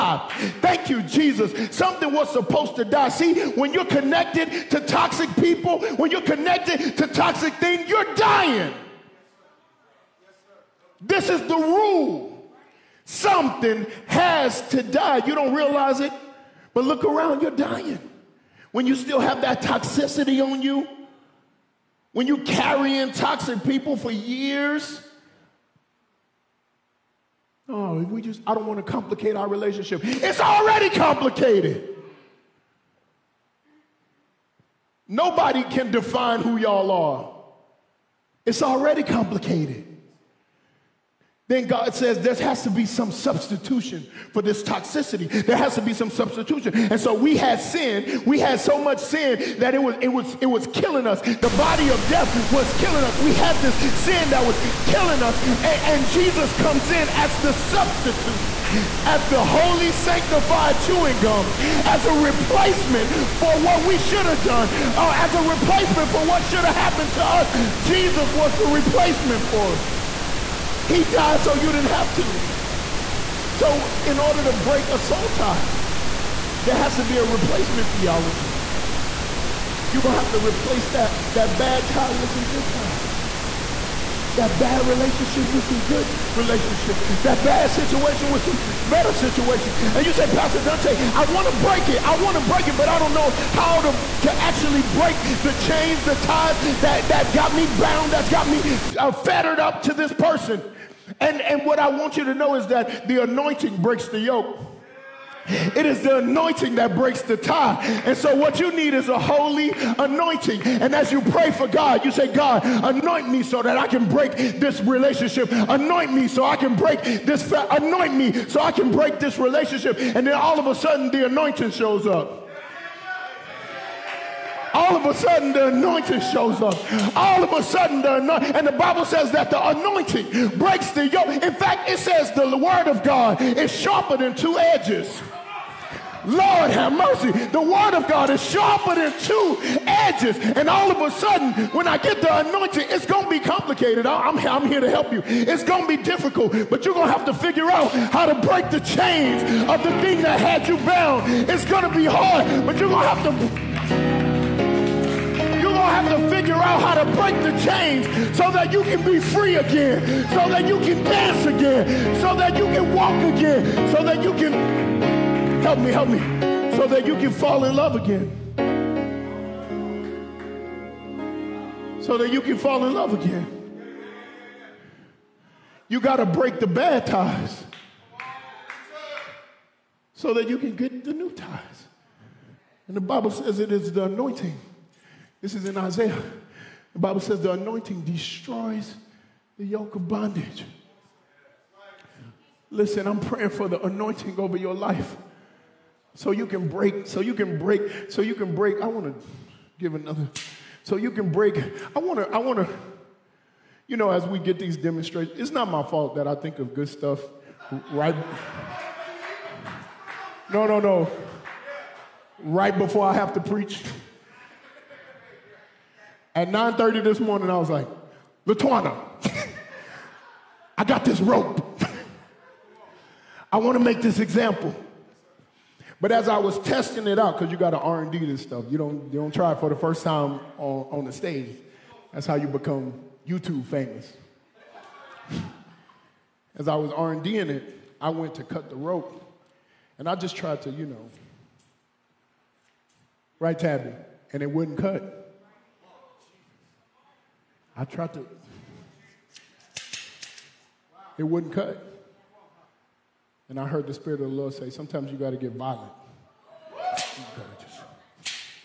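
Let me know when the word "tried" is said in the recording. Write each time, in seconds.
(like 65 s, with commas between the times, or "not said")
240 s, 247 s.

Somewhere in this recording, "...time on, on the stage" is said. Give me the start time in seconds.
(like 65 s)
230 s.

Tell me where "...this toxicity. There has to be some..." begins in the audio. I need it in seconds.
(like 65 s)
44 s.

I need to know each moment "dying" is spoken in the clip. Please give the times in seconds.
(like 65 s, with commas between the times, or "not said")
8 s, 17 s.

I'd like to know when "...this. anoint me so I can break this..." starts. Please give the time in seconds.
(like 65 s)
117 s.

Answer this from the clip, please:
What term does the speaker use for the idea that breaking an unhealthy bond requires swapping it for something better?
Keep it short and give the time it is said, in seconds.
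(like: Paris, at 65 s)
replacement theology, at 77 s.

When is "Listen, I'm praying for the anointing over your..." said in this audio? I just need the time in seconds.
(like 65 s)
192 s.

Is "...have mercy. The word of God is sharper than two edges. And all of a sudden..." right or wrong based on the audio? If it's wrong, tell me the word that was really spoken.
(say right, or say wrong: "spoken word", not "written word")
right.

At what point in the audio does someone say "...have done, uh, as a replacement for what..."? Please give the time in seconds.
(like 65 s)
64 s.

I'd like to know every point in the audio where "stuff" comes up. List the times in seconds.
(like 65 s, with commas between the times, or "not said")
206 s, 228 s.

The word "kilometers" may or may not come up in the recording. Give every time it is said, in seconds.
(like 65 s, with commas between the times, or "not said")
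not said.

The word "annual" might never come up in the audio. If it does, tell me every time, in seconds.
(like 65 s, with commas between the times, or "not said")
not said.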